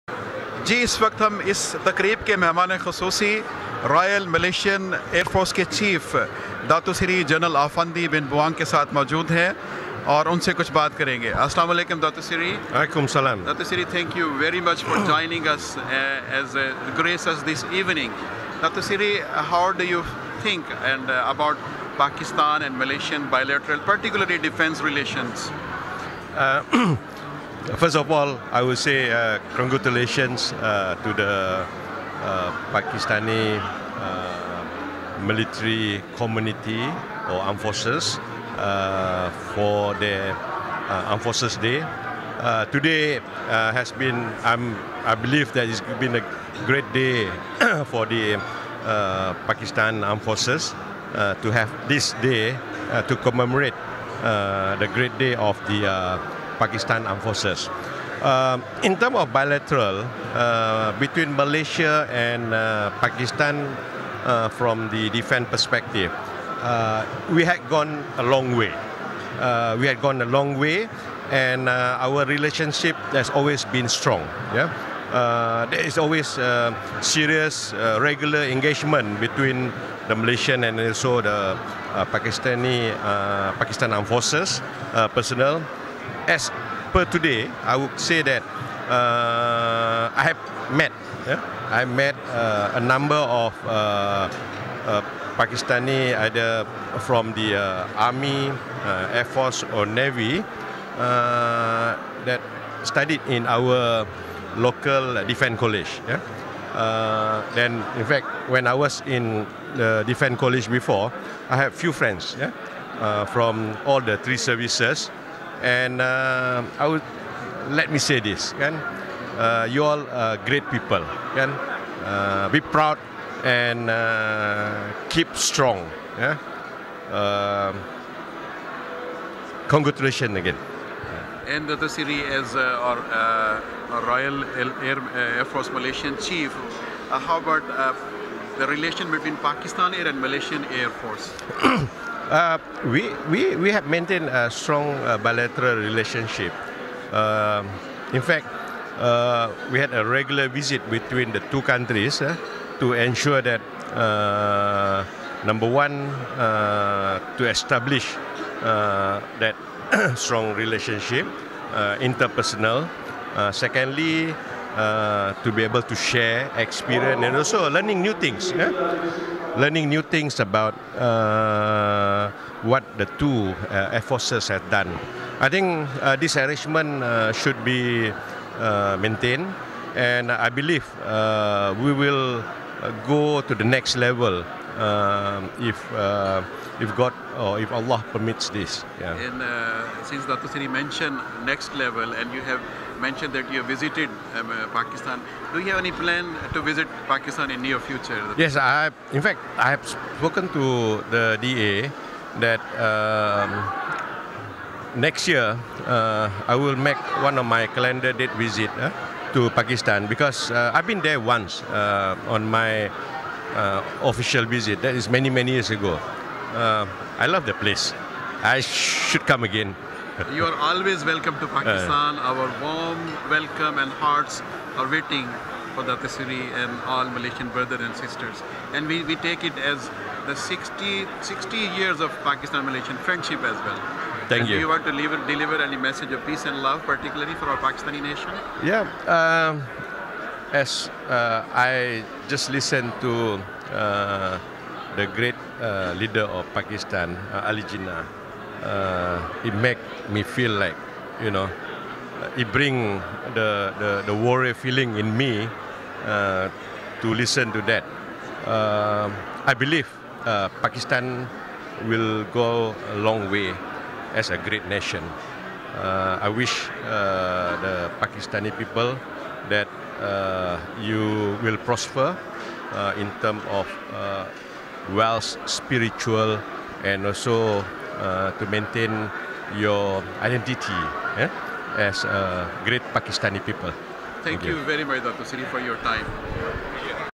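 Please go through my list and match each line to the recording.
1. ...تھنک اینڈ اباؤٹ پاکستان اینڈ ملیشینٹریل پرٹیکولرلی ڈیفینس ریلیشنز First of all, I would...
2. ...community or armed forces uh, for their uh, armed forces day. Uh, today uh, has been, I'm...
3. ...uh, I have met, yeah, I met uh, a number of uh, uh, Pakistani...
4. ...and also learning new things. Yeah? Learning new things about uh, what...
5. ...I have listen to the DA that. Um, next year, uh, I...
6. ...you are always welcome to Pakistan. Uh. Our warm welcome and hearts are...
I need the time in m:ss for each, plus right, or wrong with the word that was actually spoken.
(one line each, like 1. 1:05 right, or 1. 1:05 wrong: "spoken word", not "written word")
1. 0:20 right
2. 0:36 right
3. 1:28 right
4. 2:47 right
5. 3:19 wrong: "spoken", not "listen"
6. 3:40 right.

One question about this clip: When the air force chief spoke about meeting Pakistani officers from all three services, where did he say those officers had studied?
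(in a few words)
Local defence college.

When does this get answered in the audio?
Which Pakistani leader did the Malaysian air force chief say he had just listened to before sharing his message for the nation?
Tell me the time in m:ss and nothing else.
4:07.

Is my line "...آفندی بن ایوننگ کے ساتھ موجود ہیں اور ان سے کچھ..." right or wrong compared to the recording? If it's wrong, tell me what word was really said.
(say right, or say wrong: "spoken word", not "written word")
wrong: "بوانگ", not "ایوننگ".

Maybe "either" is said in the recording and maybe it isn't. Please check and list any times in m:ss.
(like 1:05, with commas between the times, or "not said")
1:36.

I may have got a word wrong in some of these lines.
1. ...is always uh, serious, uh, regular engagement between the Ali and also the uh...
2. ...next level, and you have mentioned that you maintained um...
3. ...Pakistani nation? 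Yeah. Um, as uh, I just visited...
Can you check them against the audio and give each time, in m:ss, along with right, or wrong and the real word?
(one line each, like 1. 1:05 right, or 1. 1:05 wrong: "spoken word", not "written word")
1. 1:15 wrong: "Malaysian", not "Ali"
2. 3:11 wrong: "visited", not "maintained"
3. 3:57 wrong: "listened", not "visited".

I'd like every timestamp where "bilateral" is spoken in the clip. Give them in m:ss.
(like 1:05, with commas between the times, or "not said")
0:59, 2:25.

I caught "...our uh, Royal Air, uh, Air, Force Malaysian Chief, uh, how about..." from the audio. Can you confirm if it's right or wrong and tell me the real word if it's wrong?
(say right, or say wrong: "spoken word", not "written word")
right.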